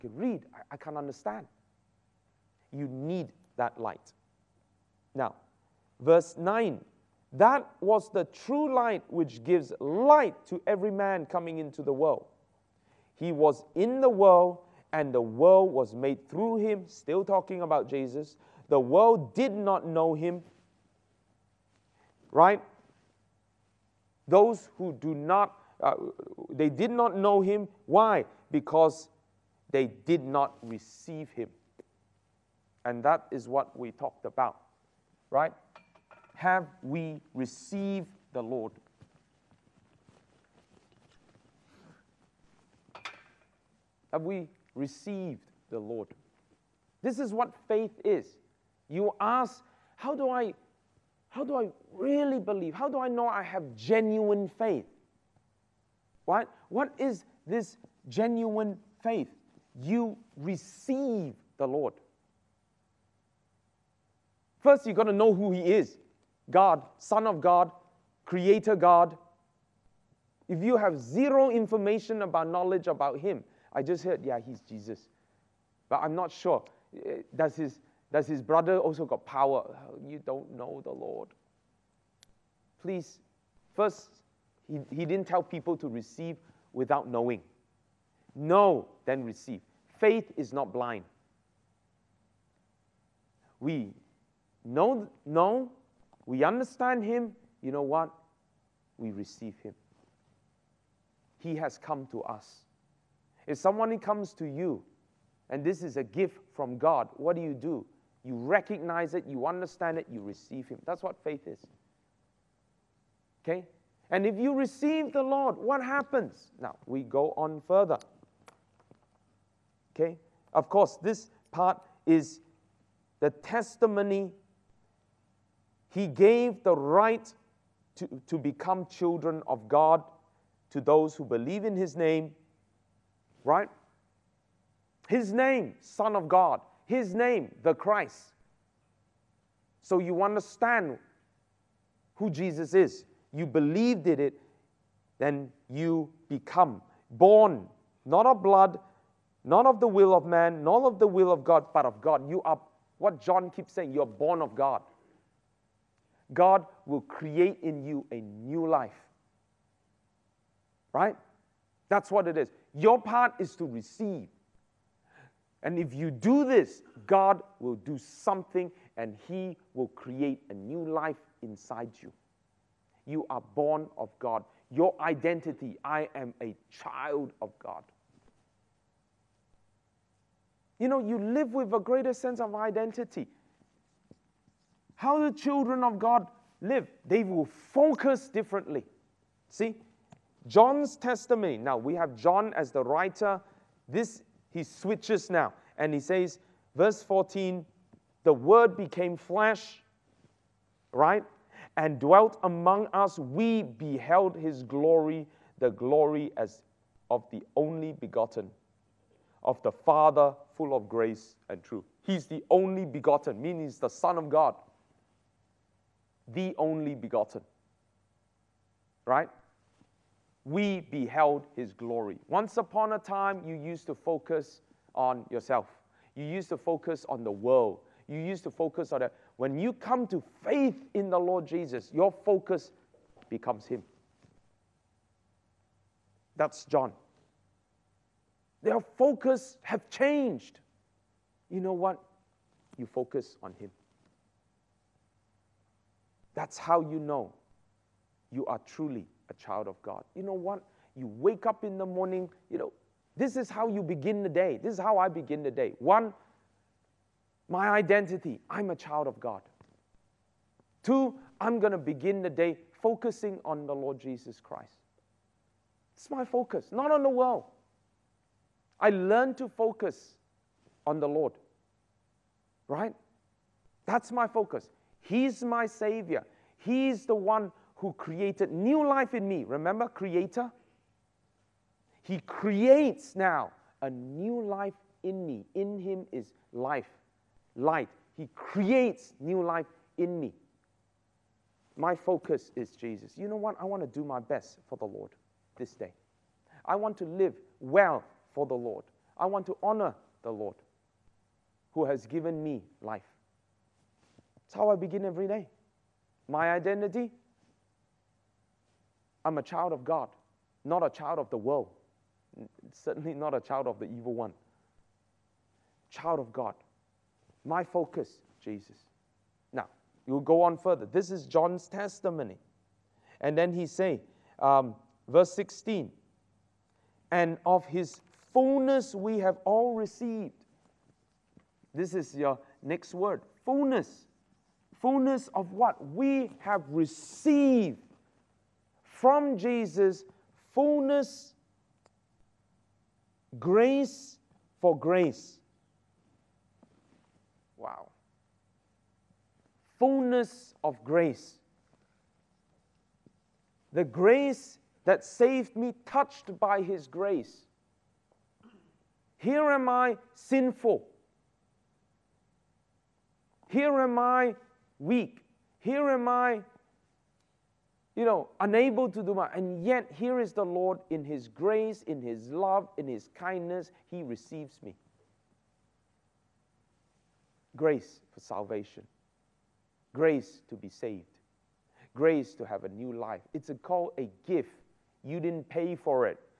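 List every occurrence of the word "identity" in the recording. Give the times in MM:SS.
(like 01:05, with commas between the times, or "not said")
02:55, 03:02, 04:17, 05:06.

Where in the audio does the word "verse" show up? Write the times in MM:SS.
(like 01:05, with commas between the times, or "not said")
00:06, 03:16, 05:25.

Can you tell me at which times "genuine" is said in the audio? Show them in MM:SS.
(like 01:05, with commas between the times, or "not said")
00:53, 00:58.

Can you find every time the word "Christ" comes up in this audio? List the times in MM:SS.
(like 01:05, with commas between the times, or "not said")
02:17, 04:24.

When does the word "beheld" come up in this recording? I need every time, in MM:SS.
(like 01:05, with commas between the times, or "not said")
03:23, 03:40.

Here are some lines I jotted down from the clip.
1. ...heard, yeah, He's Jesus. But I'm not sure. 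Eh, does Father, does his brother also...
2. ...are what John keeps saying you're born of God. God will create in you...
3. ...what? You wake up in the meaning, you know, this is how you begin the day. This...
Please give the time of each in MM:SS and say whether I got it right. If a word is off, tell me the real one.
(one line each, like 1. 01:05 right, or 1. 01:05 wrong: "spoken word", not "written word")
1. 01:14 wrong: "His", not "Father"
2. 02:32 right
3. 04:10 wrong: "morning", not "meaning".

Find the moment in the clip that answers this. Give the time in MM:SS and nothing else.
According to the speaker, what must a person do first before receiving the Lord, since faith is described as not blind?
01:04.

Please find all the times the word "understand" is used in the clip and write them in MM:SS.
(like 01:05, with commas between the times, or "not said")
00:00, 01:36, 01:49, 02:20.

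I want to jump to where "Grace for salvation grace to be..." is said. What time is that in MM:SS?
06:17.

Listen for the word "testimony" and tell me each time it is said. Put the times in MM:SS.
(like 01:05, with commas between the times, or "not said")
02:03, 03:10, 05:21.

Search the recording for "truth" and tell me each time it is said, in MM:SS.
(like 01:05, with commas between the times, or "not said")
03:31.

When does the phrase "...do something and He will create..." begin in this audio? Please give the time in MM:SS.
02:47.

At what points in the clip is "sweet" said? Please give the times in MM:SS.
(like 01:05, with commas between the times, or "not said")
not said.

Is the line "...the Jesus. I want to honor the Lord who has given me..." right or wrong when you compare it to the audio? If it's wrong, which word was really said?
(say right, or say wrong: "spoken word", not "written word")
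wrong: "Lord", not "Jesus".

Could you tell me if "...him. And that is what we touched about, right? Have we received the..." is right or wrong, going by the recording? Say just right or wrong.
wrong.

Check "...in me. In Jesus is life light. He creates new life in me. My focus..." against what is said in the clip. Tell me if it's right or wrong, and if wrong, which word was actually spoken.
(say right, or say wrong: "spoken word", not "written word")
wrong: "Him", not "Jesus".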